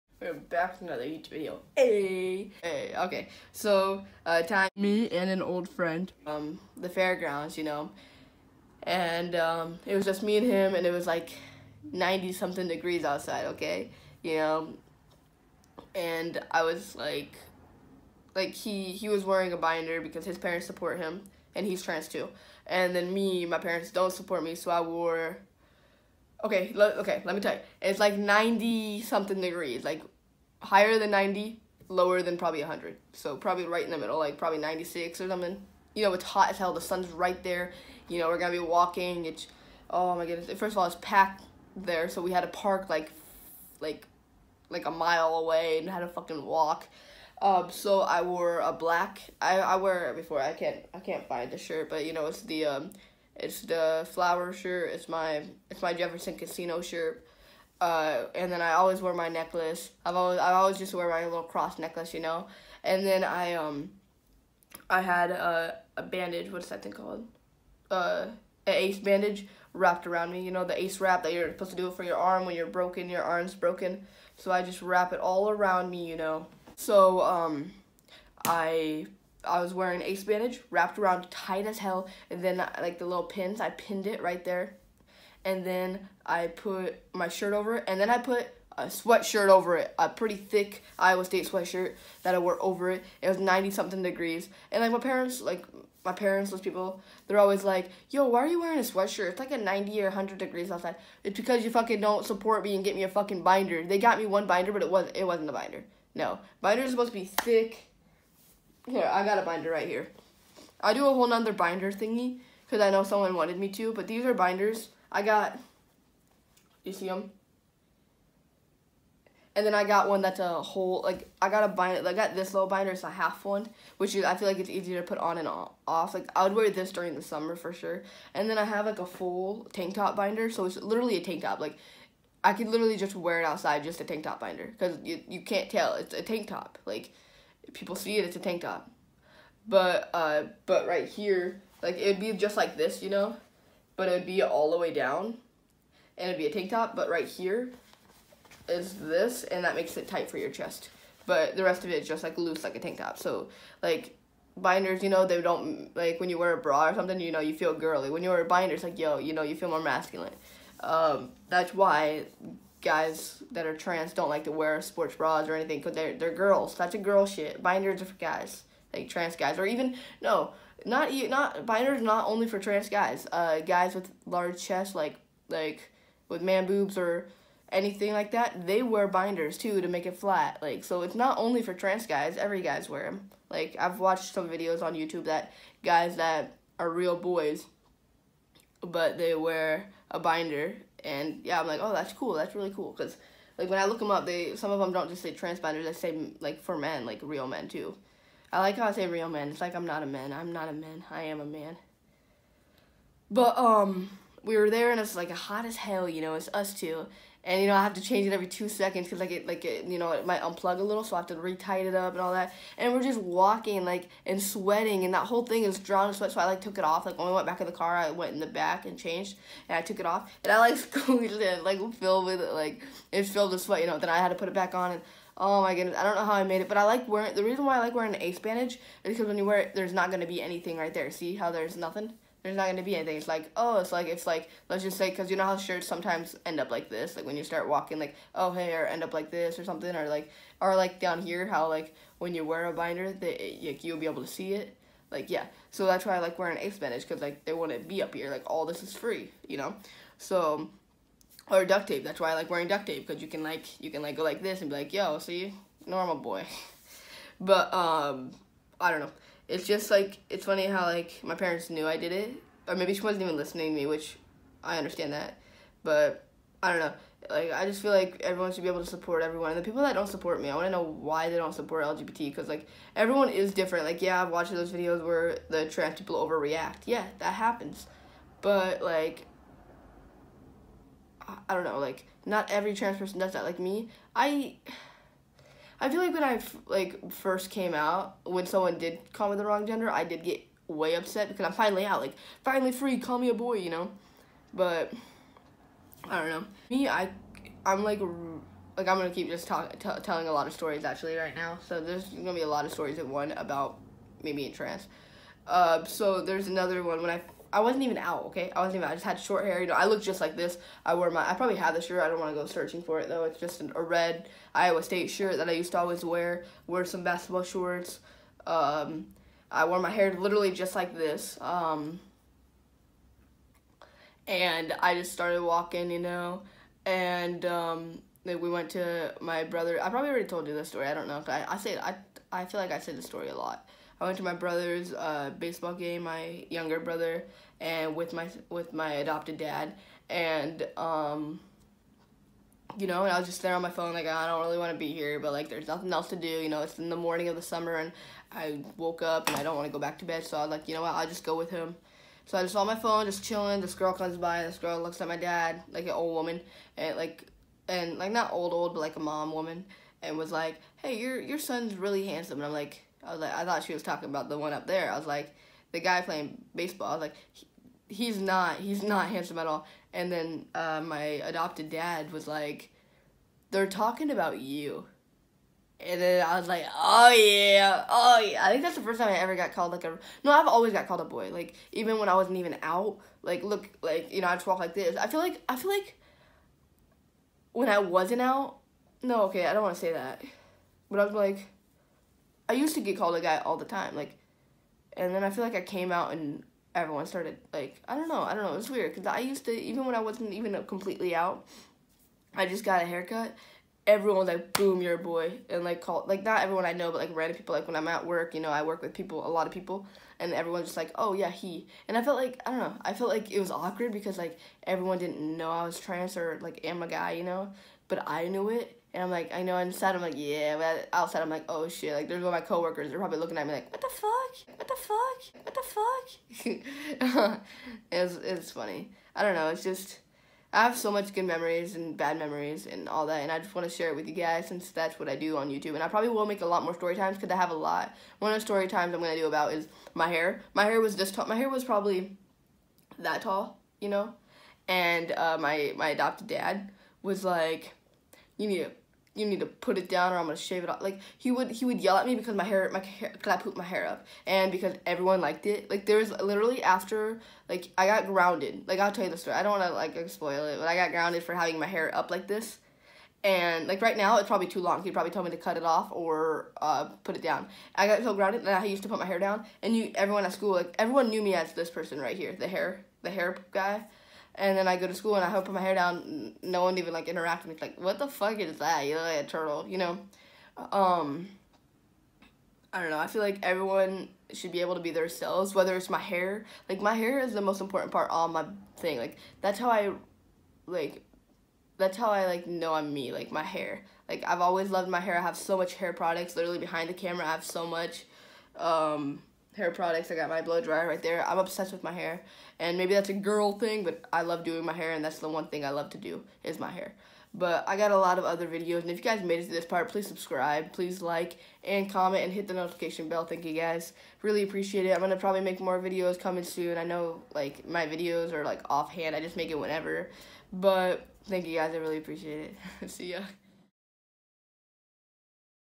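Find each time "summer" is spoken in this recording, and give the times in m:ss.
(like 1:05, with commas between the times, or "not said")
2:07, 5:47.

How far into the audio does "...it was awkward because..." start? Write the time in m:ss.
6:53.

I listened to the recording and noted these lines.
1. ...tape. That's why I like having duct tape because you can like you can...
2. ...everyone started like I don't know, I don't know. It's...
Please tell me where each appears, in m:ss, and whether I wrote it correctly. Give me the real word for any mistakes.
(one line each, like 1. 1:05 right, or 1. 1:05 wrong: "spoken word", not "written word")
1. 4:11 wrong: "wearing", not "having"
2. 6:36 right.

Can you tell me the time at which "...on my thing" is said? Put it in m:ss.
8:08.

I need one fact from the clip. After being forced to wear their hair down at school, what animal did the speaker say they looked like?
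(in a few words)
A turtle.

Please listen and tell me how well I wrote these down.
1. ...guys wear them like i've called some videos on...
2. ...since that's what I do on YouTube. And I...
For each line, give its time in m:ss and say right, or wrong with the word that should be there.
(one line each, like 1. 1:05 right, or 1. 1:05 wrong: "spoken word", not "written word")
1. 3:02 wrong: "watched", not "called"
2. 7:14 right.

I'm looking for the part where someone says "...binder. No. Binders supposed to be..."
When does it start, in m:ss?
1:45.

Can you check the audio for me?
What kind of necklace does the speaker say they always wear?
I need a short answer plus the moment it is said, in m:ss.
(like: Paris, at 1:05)
Cross necklace, at 1:01.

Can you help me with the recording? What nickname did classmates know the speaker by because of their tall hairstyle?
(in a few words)
The hair guy.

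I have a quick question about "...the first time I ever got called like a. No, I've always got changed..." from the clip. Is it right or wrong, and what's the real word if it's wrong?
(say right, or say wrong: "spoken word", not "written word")
wrong: "called", not "changed".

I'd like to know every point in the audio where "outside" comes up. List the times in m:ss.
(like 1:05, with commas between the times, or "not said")
0:13, 1:40, 2:13, 7:00.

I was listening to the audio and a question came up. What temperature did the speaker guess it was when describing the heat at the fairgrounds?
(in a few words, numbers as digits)
96.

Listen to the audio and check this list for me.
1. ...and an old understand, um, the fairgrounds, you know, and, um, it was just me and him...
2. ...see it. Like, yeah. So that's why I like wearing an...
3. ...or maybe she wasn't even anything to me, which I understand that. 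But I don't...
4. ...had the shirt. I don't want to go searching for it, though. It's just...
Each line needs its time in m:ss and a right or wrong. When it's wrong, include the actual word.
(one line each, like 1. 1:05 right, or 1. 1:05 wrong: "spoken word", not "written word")
1. 0:05 wrong: "friend", not "understand"
2. 4:04 right
3. 4:22 wrong: "listening", not "anything"
4. 5:11 right.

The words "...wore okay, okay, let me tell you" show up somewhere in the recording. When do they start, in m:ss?
0:24.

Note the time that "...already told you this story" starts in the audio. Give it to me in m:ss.
5:30.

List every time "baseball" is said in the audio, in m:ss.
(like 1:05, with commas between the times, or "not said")
5:35, 6:06.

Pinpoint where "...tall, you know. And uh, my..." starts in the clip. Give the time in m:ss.
7:23.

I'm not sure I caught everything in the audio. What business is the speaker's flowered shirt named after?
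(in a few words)
Jefferson Casino.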